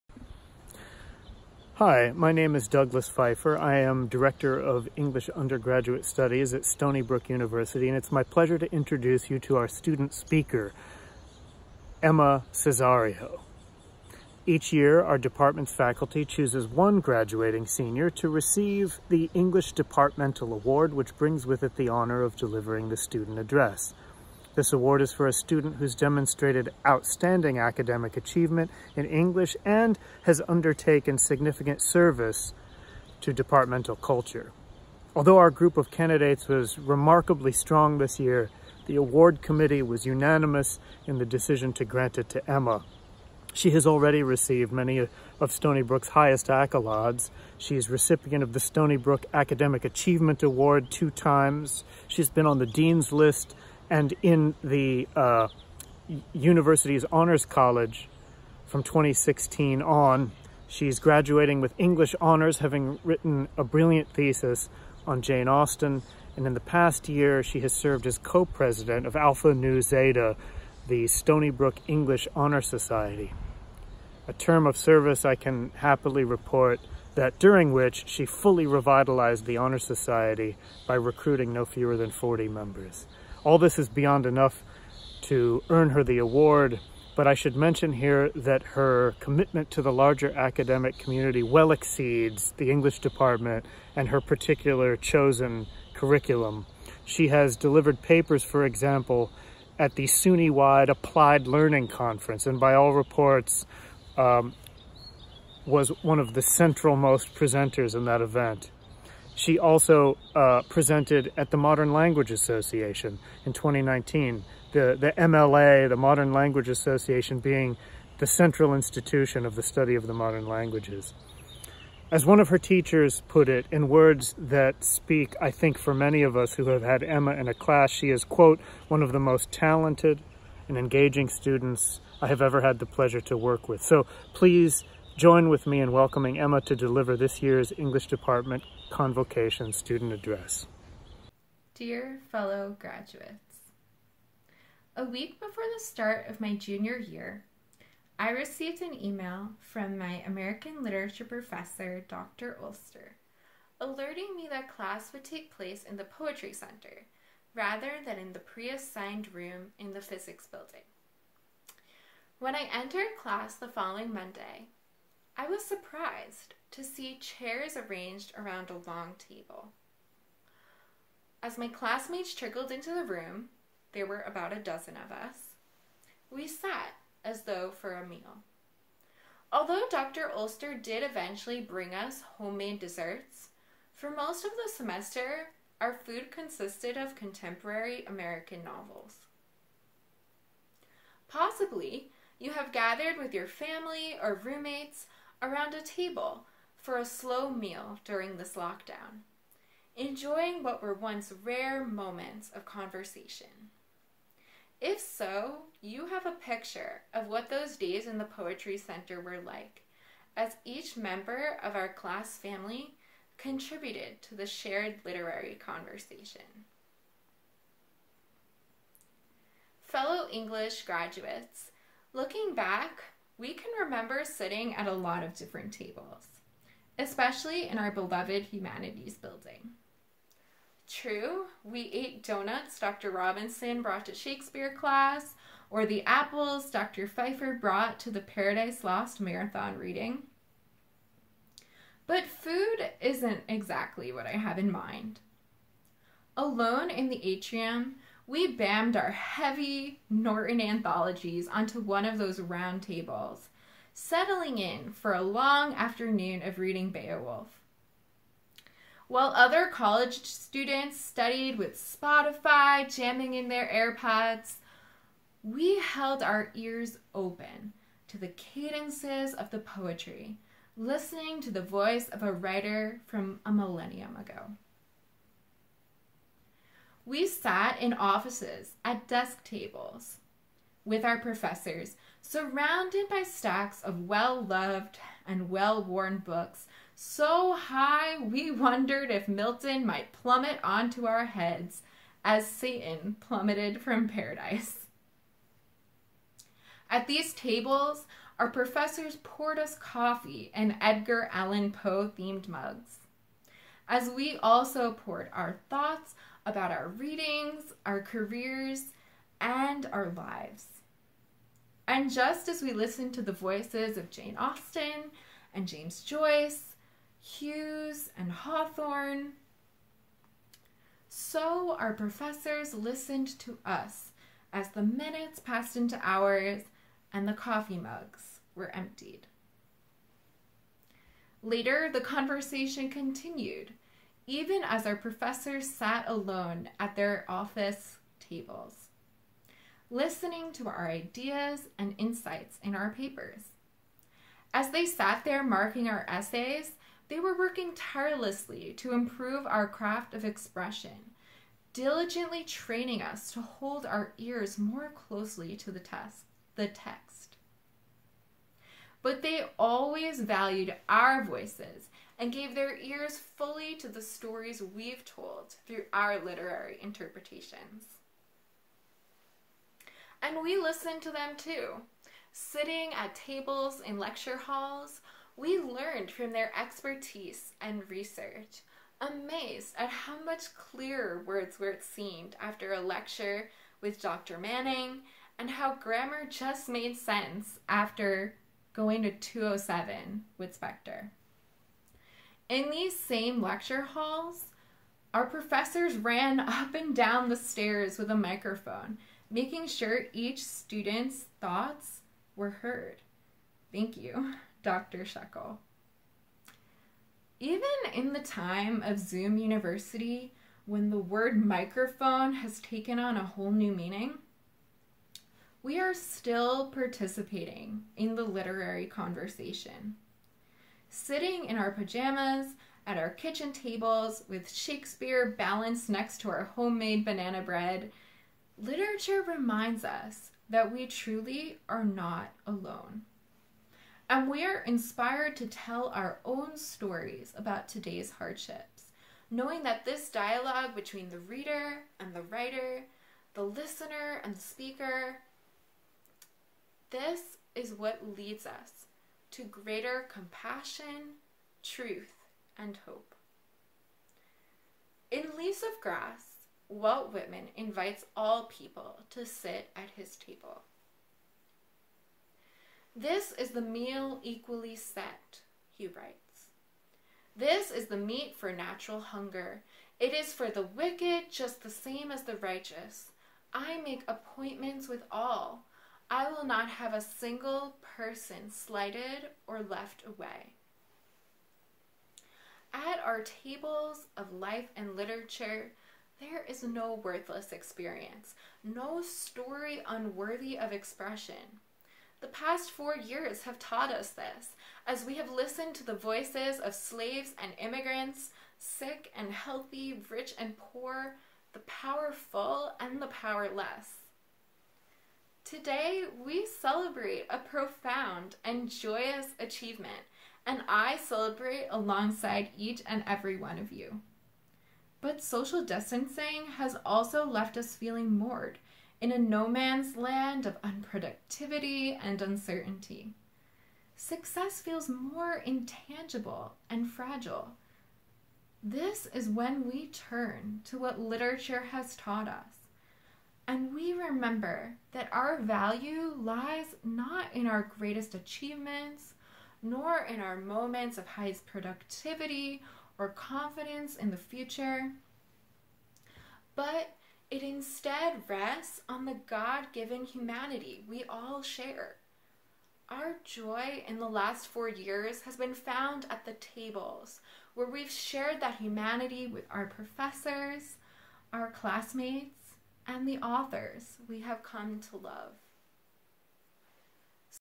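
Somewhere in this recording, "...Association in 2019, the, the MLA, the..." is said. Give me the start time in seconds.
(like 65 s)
112 s.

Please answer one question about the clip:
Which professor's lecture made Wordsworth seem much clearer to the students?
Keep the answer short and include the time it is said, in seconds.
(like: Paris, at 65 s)
Dr. Manning, at 383 s.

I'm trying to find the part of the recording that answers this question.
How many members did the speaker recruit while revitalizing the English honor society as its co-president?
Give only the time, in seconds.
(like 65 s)
82 s.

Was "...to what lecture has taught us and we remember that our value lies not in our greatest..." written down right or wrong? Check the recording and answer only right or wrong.
wrong.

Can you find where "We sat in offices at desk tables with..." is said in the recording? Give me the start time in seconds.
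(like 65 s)
277 s.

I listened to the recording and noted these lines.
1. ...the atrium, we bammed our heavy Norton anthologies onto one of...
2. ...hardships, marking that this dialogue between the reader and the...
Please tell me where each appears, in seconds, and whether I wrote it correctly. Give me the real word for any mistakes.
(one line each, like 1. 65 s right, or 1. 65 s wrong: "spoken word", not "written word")
1. 247 s right
2. 438 s wrong: "knowing", not "marking".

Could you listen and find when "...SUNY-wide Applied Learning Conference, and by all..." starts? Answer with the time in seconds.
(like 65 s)
100 s.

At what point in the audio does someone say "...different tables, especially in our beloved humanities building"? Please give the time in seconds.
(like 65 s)
225 s.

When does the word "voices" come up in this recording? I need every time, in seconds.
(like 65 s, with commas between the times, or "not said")
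271 s, 313 s, 361 s, 495 s.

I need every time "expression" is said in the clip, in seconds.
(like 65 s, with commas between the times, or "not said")
350 s, 490 s.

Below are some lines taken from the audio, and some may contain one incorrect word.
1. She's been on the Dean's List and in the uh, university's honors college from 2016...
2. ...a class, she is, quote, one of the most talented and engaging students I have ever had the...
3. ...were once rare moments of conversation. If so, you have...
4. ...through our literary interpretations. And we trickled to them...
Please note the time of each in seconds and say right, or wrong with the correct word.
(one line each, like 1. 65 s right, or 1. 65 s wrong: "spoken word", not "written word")
1. 52 s right
2. 127 s right
3. 200 s right
4. 365 s wrong: "listened", not "trickled".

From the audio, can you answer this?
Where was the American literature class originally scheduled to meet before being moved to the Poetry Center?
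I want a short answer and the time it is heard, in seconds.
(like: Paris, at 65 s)
physics building, at 160 s.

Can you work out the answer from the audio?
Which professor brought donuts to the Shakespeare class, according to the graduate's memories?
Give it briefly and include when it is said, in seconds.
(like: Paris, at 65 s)
Dr. Robinson, at 232 s.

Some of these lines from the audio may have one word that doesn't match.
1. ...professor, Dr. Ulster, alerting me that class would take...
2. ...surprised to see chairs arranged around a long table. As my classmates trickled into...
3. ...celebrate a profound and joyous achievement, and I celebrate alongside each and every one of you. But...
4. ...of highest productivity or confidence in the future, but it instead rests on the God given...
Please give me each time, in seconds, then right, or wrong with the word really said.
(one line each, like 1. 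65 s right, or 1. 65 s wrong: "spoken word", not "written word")
1. 151 s right
2. 165 s right
3. 506 s right
4. 540 s right.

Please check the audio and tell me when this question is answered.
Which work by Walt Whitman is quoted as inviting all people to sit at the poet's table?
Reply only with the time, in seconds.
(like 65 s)
455 s.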